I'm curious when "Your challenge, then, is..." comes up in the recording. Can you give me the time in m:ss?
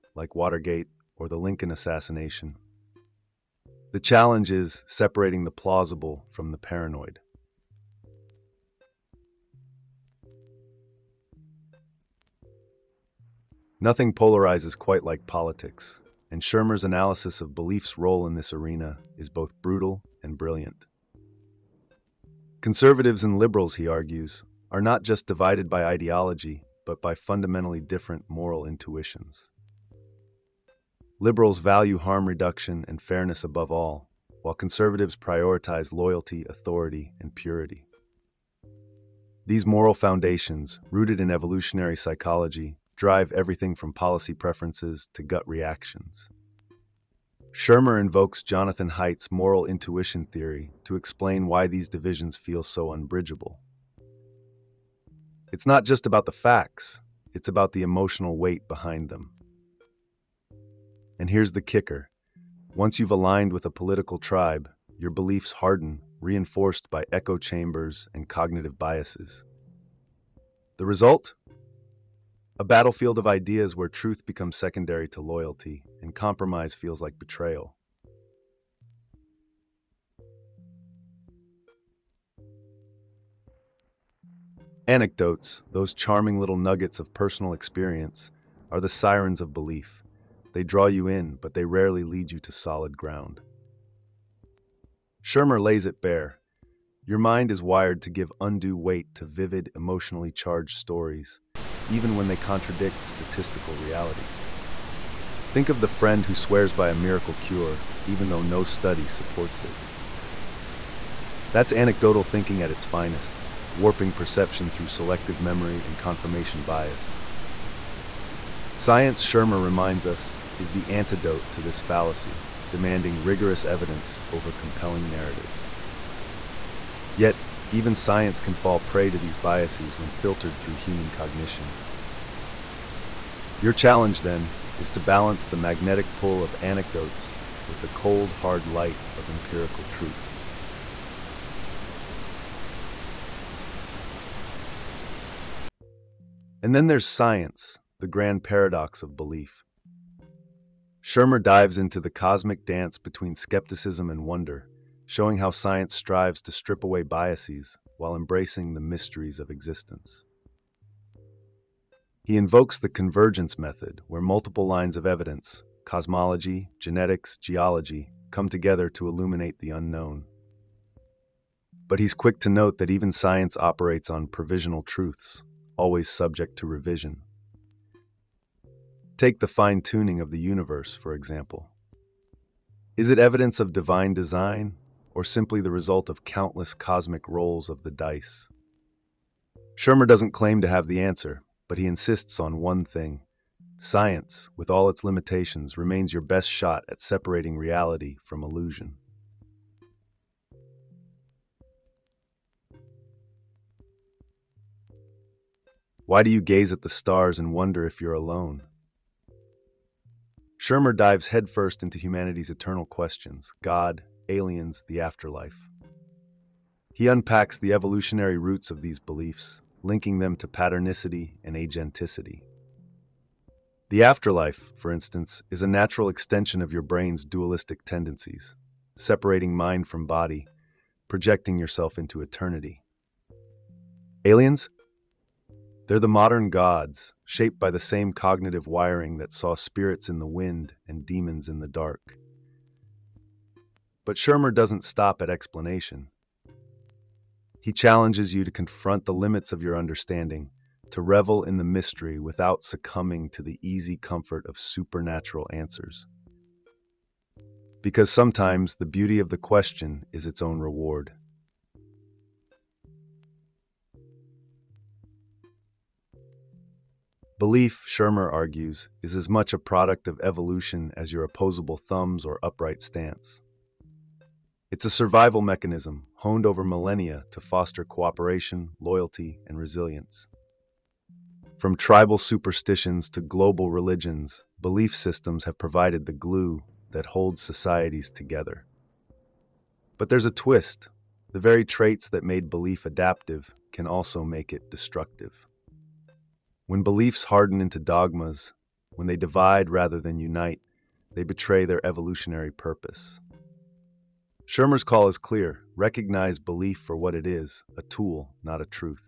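2:13.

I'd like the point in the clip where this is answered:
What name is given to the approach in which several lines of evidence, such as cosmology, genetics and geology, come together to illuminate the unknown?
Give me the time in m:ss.
2:42.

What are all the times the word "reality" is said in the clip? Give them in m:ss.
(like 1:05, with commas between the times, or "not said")
1:43, 3:17.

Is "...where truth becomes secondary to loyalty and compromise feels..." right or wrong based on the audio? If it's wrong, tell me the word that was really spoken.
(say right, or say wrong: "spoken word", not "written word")
right.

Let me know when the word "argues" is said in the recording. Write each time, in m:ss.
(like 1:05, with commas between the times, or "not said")
0:23, 4:28.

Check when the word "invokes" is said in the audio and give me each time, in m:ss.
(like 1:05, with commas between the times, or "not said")
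0:47, 2:42.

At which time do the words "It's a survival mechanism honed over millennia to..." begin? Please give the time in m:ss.
4:34.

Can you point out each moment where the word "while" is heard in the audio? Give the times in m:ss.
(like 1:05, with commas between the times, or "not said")
0:34, 2:37.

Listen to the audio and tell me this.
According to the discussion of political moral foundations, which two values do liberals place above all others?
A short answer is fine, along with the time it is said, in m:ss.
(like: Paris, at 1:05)
harm reduction and fairness, at 0:31.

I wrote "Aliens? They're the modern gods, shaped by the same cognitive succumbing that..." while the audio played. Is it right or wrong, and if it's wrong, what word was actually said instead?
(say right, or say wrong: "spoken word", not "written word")
wrong: "wiring", not "succumbing".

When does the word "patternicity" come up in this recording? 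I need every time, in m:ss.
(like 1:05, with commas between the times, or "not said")
3:40.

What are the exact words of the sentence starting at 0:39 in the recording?
These moral foundations, rooted in evolutionary psychology, drive everything from policy preferences to gut reactions.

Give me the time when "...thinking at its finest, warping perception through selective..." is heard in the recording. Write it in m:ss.
1:52.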